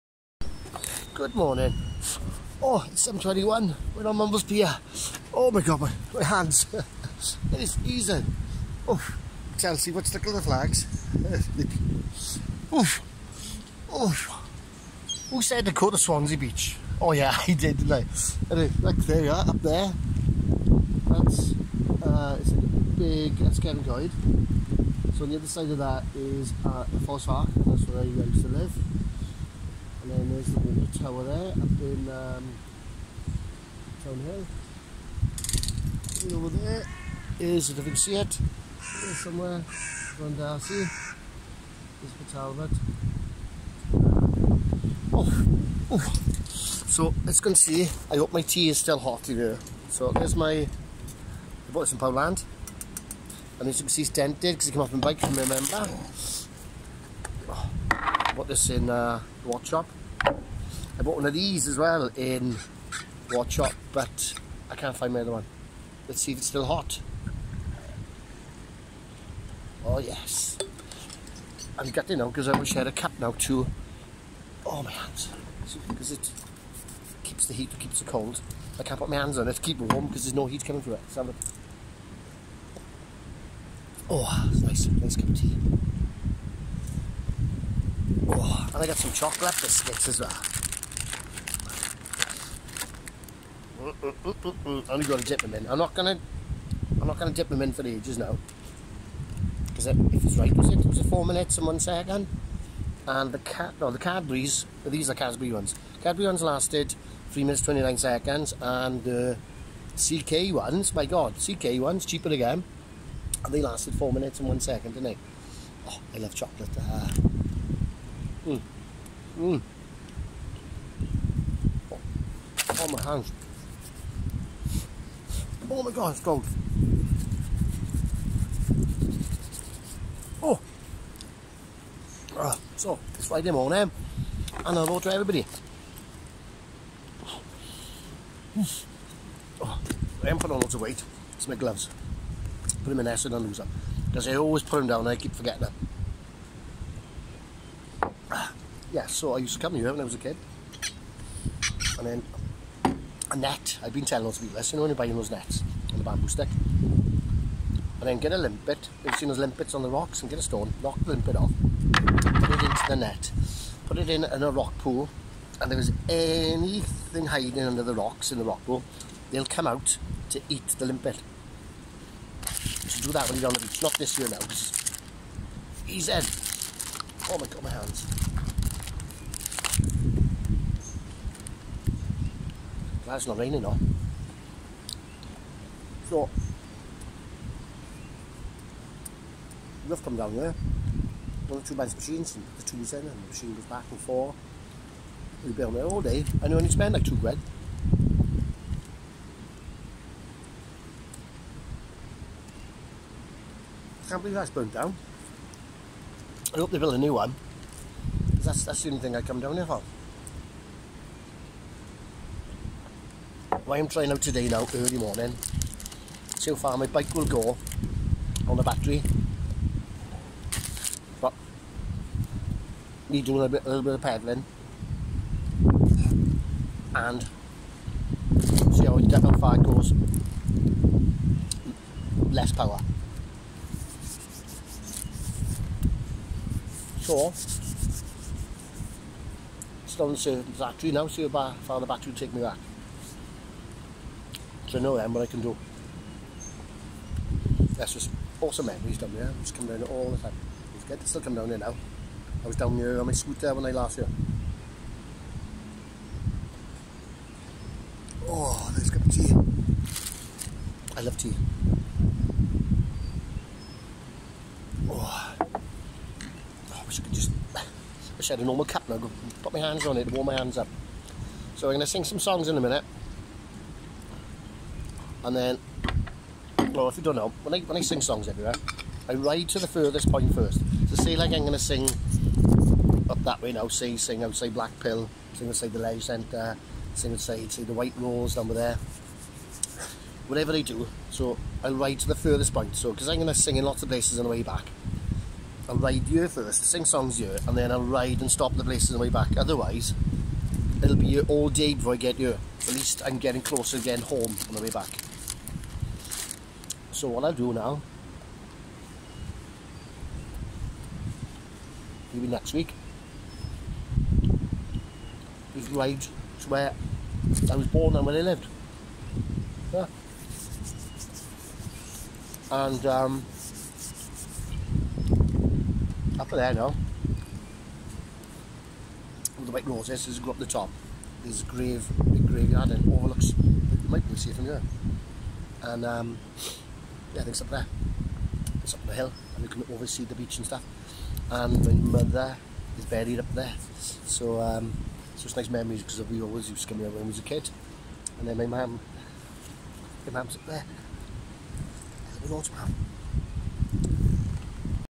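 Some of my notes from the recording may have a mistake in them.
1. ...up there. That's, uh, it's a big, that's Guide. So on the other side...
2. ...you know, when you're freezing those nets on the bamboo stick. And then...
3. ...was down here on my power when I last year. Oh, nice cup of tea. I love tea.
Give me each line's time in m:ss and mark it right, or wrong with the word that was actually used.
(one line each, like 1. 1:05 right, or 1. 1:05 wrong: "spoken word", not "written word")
1. 0:19 right
2. 2:34 wrong: "buying", not "freezing"
3. 4:12 wrong: "scooter", not "power".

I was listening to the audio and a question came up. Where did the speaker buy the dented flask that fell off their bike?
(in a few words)
Poundland.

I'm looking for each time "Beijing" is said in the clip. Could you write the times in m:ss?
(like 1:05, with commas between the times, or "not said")
not said.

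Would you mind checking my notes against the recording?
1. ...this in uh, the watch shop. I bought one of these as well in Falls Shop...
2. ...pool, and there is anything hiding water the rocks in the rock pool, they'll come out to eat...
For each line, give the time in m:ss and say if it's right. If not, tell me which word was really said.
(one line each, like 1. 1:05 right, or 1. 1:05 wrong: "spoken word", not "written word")
1. 0:58 wrong: "Watch", not "Falls"
2. 2:44 wrong: "under", not "water".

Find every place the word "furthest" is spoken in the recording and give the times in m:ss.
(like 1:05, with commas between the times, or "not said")
4:39, 4:52.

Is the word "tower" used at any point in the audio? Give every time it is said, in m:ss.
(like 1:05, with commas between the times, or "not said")
0:30.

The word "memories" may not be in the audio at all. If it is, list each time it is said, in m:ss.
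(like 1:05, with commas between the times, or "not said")
4:08, 5:45.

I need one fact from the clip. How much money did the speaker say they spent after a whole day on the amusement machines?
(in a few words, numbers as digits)
2 quid.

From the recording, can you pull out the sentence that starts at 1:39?
Because if it's right, was it?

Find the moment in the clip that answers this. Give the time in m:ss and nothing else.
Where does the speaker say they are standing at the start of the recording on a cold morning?
0:04.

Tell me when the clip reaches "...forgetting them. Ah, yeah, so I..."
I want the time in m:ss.
2:25.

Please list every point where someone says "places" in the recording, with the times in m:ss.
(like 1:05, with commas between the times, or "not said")
4:53, 4:58.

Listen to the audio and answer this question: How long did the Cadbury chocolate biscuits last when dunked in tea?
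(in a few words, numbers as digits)
3 minutes 29 seconds.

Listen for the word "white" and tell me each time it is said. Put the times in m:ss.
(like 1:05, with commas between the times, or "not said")
4:47, 5:29.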